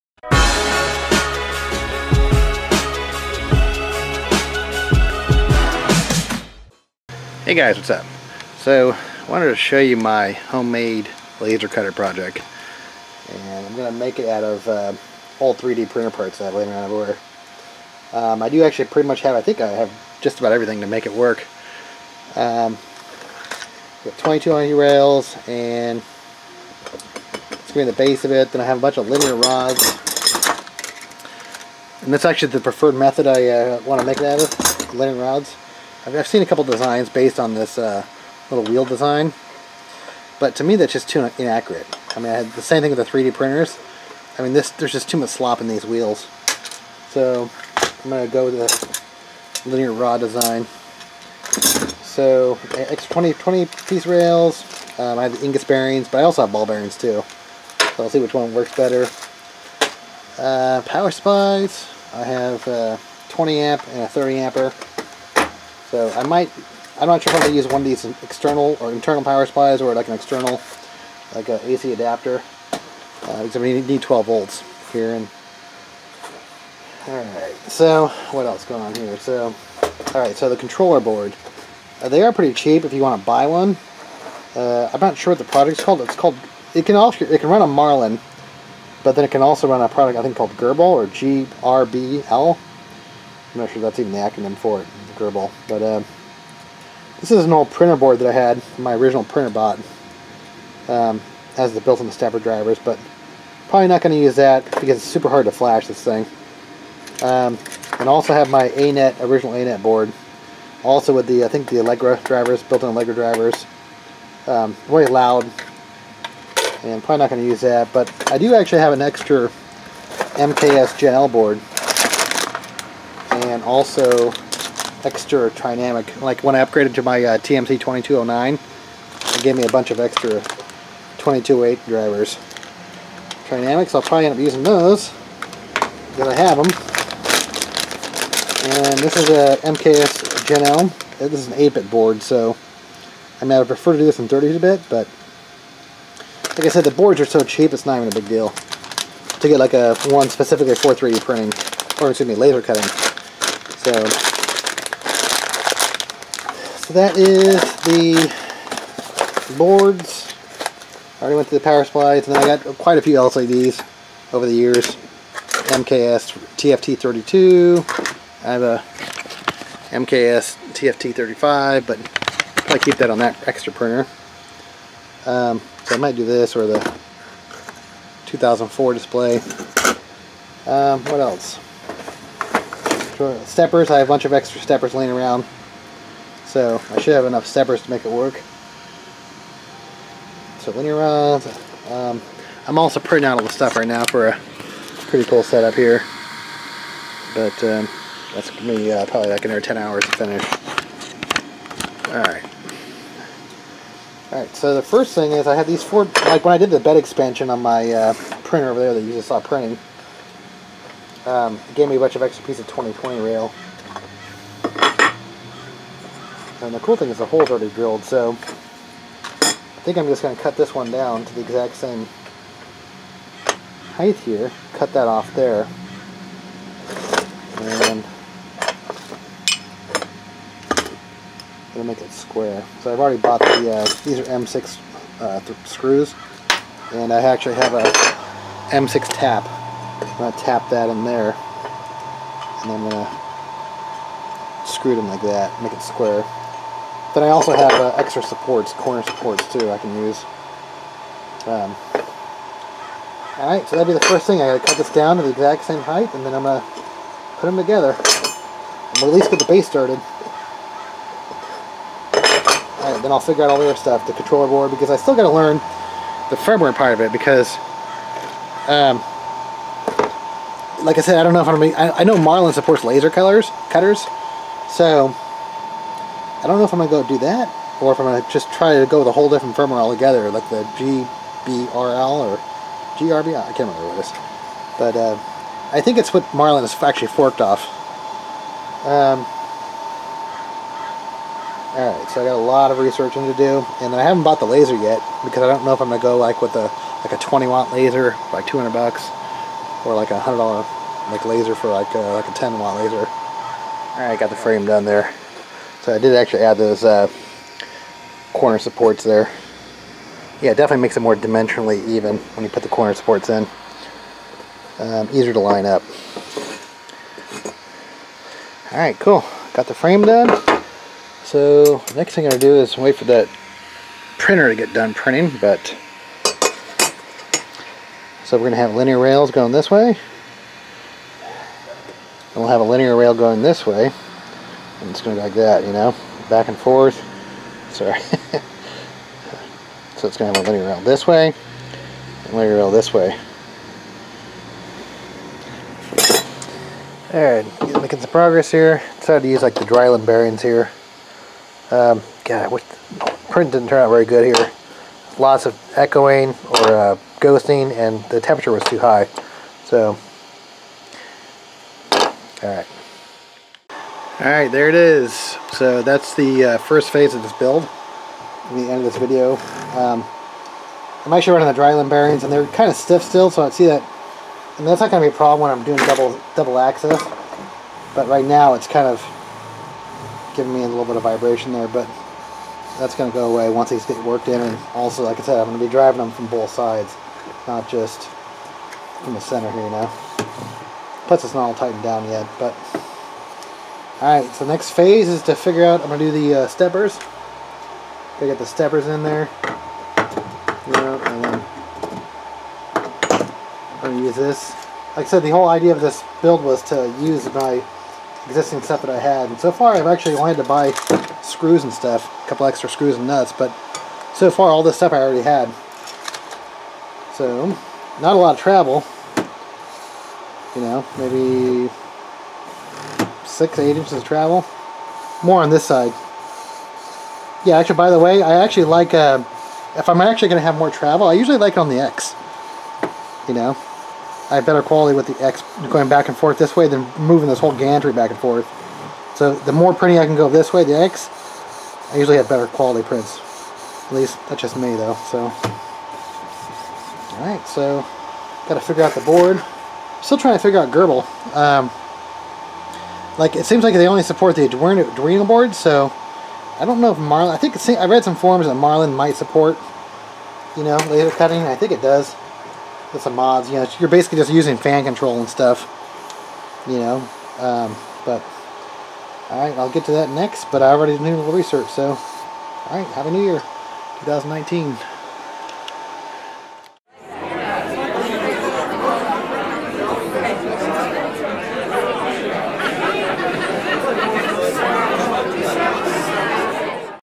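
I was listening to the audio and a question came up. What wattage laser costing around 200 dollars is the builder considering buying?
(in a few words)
20 watt.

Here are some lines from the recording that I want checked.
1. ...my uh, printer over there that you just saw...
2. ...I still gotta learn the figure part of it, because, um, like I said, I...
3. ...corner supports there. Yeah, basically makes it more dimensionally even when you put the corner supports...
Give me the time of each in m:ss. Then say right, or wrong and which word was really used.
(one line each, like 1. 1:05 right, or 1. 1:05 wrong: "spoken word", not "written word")
1. 3:27 right
2. 4:24 wrong: "firmware", not "figure"
3. 5:08 wrong: "definitely", not "basically".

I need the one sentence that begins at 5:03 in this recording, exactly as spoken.
Alright, got the frame done there.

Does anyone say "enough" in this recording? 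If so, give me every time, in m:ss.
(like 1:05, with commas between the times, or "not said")
3:07.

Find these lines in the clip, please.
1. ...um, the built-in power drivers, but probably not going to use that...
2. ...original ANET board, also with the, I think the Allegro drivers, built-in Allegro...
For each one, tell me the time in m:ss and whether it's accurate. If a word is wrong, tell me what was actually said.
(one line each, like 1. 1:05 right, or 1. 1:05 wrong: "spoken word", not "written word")
1. 1:40 wrong: "stepper", not "power"
2. 1:49 right.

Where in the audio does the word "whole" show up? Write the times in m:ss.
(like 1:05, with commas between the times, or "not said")
4:39, 6:45, 7:17.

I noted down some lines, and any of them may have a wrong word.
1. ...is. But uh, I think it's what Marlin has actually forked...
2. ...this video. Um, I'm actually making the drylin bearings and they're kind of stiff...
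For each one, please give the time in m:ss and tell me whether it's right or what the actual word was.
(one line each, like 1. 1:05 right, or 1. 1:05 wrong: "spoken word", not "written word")
1. 4:44 right
2. 6:08 wrong: "running", not "making".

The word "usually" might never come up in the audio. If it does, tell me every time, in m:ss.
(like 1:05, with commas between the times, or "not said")
7:11, 7:21.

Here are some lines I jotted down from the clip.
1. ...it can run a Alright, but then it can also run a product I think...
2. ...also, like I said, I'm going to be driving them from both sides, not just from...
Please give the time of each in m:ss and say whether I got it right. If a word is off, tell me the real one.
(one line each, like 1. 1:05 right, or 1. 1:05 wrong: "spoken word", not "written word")
1. 1:27 wrong: "Marlin", not "Alright"
2. 6:24 right.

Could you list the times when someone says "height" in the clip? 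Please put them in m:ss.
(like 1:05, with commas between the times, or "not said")
3:43, 4:15.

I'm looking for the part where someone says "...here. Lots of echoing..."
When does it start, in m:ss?
5:54.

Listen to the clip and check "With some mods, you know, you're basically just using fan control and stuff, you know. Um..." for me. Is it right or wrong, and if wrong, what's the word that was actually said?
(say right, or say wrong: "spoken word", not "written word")
right.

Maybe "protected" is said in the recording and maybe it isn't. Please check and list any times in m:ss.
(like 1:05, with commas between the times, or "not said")
not said.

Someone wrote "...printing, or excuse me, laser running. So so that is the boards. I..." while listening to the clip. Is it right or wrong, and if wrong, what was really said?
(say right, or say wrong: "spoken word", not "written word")
wrong: "cutting", not "running".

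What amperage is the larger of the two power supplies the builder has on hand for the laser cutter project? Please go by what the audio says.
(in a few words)
30 amp.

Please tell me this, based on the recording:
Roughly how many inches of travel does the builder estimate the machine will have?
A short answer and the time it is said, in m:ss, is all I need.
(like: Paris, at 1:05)
6 to 8 inches, at 7:03.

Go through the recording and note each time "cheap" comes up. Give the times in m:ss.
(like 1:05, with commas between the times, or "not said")
1:22, 2:27.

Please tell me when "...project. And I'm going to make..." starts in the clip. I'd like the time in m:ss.
0:11.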